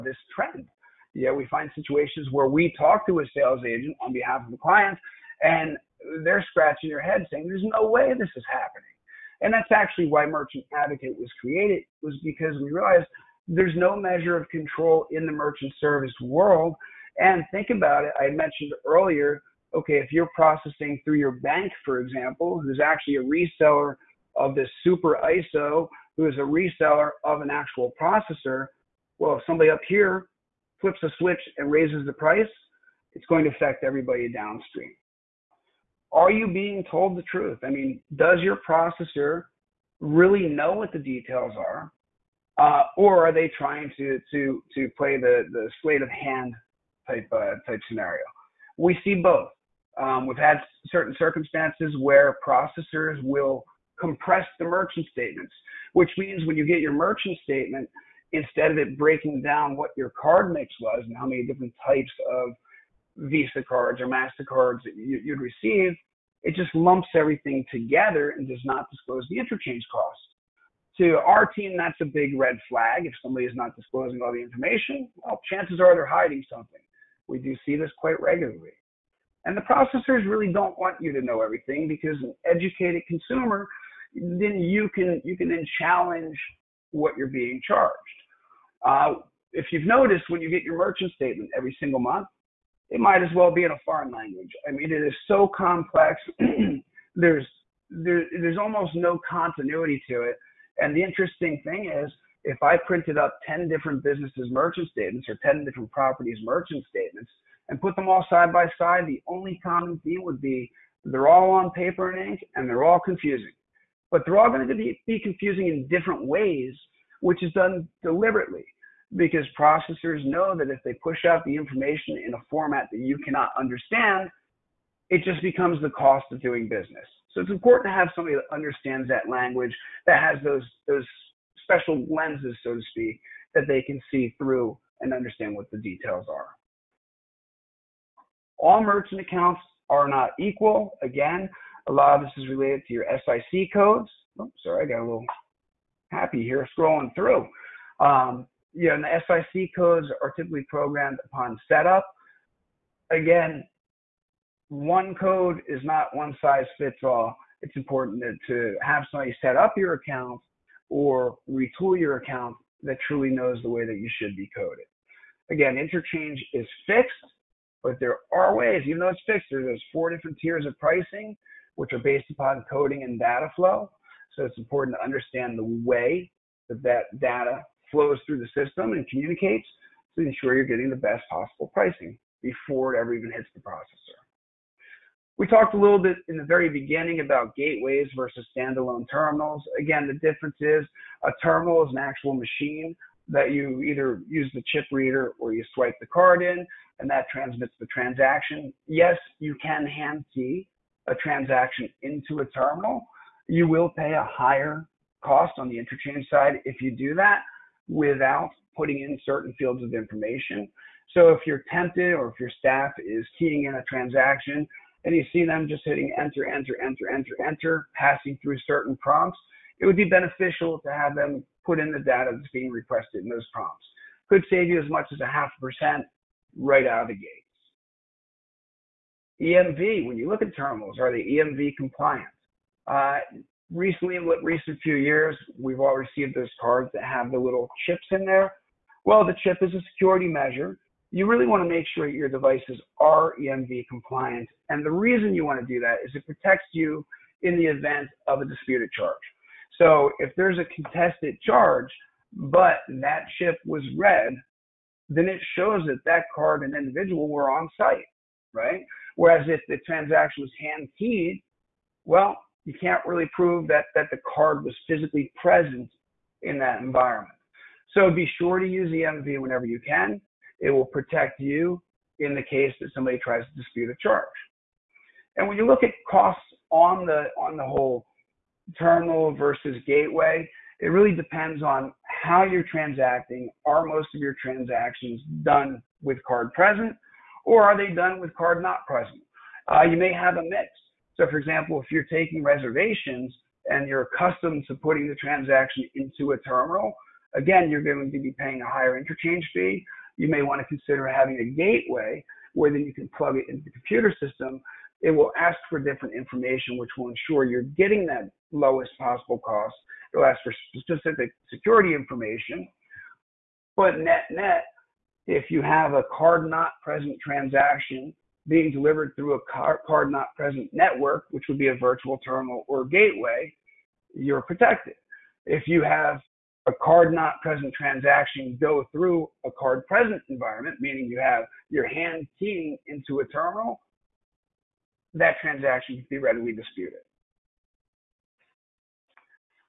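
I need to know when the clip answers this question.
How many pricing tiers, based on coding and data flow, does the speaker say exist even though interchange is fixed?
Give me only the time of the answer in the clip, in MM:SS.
02:49.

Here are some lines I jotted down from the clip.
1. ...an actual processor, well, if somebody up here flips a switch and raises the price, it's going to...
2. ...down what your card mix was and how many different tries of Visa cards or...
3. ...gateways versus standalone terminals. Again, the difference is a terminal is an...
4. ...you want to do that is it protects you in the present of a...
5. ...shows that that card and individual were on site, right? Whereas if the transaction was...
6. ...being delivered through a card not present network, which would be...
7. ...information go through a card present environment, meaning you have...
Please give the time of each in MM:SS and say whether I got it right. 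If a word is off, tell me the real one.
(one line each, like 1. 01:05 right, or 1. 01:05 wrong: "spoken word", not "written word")
1. 00:27 right
2. 00:59 wrong: "types", not "tries"
3. 03:07 right
4. 04:05 wrong: "event", not "present"
5. 04:15 right
6. 05:18 right
7. 05:27 wrong: "transaction", not "information".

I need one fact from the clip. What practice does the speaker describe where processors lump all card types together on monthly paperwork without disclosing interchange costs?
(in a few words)
compress the merchant statements.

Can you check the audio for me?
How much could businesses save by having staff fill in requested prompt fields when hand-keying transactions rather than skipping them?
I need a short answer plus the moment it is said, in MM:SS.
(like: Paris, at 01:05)
half percent, at 03:45.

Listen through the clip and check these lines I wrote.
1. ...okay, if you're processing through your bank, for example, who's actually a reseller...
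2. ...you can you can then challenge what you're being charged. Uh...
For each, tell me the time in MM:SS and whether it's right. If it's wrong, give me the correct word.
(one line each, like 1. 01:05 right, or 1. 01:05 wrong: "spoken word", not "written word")
1. 00:19 right
2. 01:24 right.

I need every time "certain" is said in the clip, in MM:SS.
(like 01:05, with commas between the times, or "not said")
00:50, 03:29, 03:38.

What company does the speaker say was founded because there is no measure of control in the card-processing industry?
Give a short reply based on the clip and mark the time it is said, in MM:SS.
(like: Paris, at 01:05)
Merchant Advocate, at 00:10.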